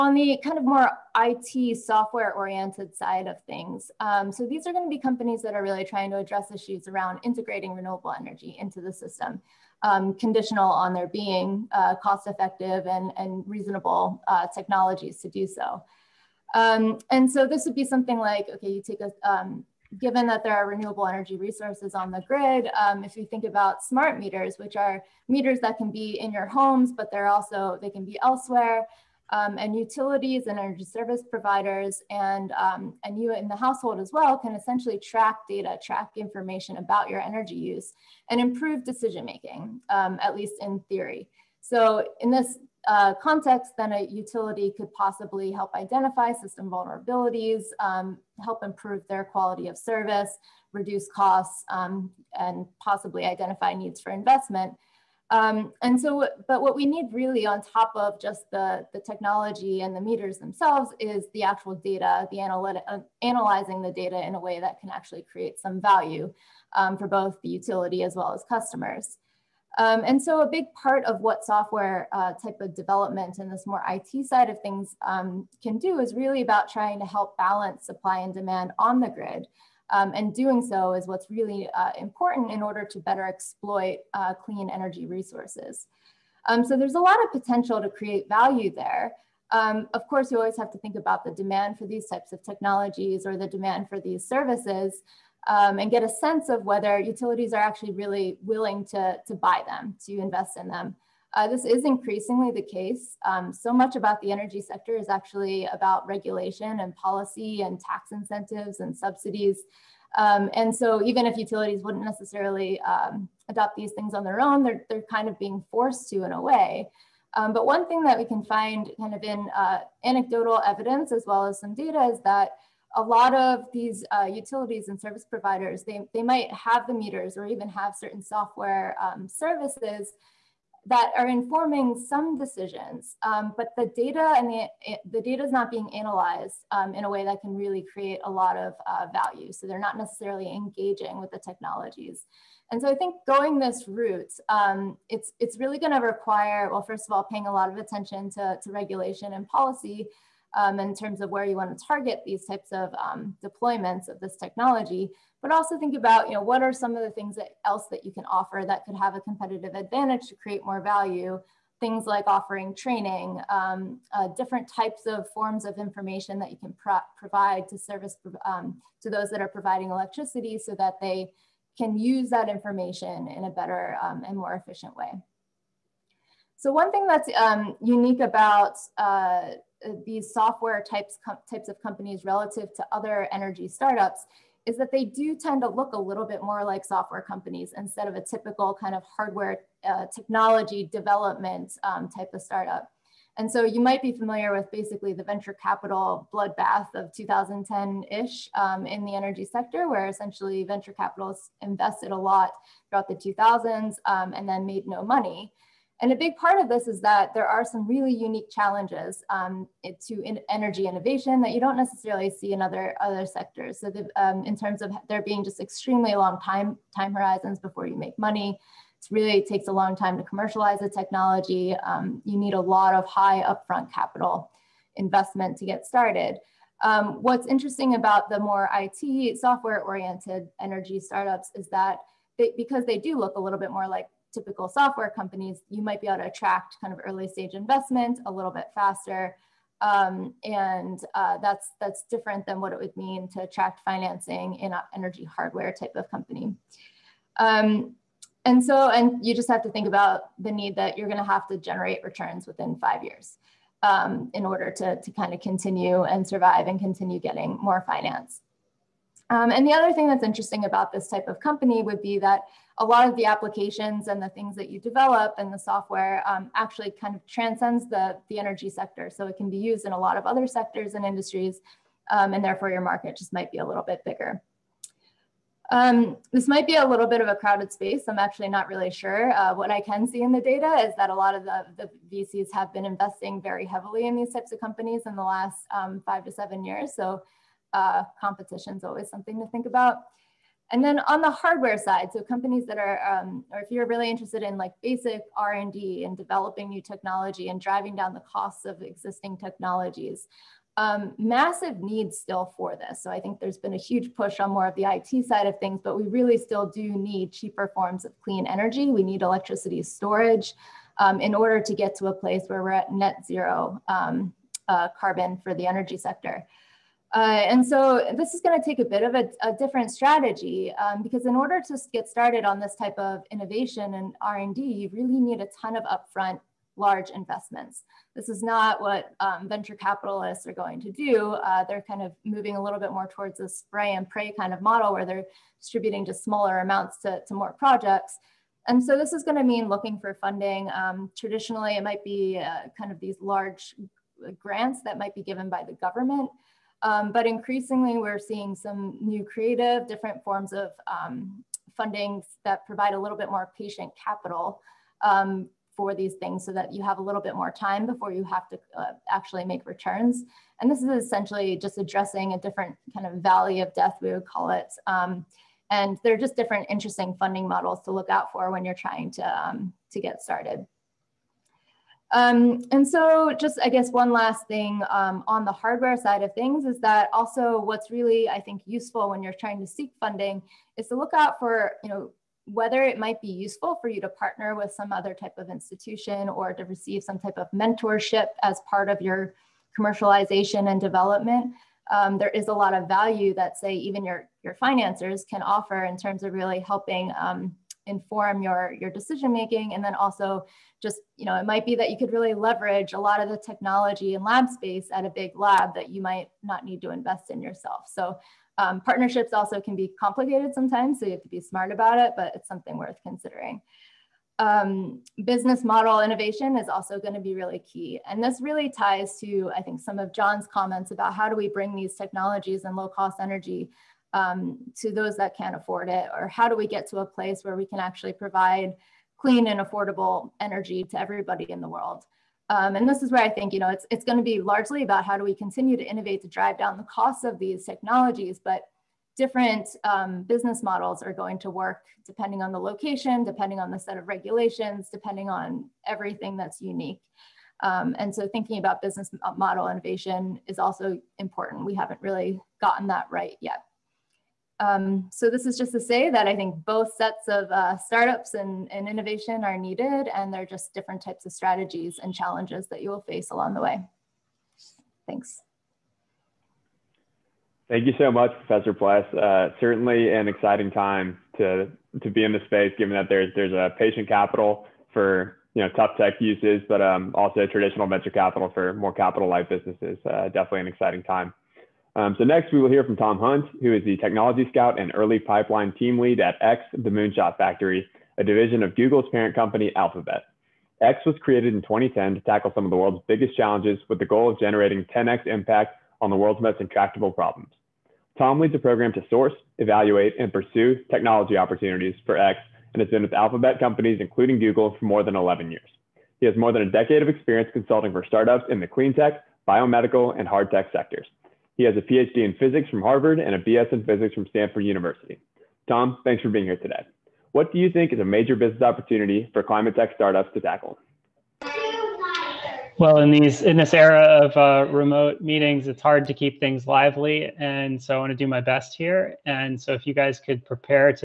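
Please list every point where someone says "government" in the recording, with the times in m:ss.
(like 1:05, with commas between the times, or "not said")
5:45.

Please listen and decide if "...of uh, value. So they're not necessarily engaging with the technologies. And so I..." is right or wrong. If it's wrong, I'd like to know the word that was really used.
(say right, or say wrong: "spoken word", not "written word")
right.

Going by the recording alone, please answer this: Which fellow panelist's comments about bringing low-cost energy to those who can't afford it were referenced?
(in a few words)
John.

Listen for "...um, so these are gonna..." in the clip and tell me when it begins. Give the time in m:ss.
0:03.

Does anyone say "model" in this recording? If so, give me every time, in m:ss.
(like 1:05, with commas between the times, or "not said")
5:34, 6:07, 6:55, 7:20, 7:29.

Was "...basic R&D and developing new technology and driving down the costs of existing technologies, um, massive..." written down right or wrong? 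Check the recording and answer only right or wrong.
right.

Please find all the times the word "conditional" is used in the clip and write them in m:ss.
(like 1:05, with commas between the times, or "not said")
0:10.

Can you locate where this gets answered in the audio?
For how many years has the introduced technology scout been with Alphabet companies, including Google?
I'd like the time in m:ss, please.
8:24.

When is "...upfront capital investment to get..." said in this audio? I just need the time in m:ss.
3:43.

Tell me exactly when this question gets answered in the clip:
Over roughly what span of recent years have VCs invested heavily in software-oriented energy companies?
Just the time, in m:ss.
4:46.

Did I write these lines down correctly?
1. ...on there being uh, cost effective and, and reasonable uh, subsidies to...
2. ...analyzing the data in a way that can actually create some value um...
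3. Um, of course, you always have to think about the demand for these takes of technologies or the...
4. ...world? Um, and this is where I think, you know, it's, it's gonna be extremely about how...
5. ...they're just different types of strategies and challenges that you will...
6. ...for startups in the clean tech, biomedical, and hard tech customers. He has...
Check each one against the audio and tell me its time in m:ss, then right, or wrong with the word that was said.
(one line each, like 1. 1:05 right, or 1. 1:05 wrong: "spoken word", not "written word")
1. 0:10 wrong: "technologies", not "subsidies"
2. 1:03 right
3. 1:29 wrong: "types", not "takes"
4. 7:11 wrong: "largely", not "extremely"
5. 7:40 right
6. 8:27 wrong: "sectors", not "customers".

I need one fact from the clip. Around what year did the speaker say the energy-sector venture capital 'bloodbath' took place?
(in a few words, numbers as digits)
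2010.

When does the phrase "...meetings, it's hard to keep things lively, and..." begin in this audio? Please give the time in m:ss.
8:45.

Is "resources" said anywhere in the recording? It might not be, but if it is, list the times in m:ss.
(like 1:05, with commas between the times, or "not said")
0:21, 1:25.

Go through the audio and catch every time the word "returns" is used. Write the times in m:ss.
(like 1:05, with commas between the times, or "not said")
4:12, 5:59.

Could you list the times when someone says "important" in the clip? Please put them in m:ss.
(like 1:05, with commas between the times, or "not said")
1:21, 7:31.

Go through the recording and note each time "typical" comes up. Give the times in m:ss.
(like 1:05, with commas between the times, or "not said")
3:08, 3:54.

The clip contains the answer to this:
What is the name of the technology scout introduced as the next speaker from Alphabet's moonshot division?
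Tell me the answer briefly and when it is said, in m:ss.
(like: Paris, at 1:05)
Tom Hunt, at 8:02.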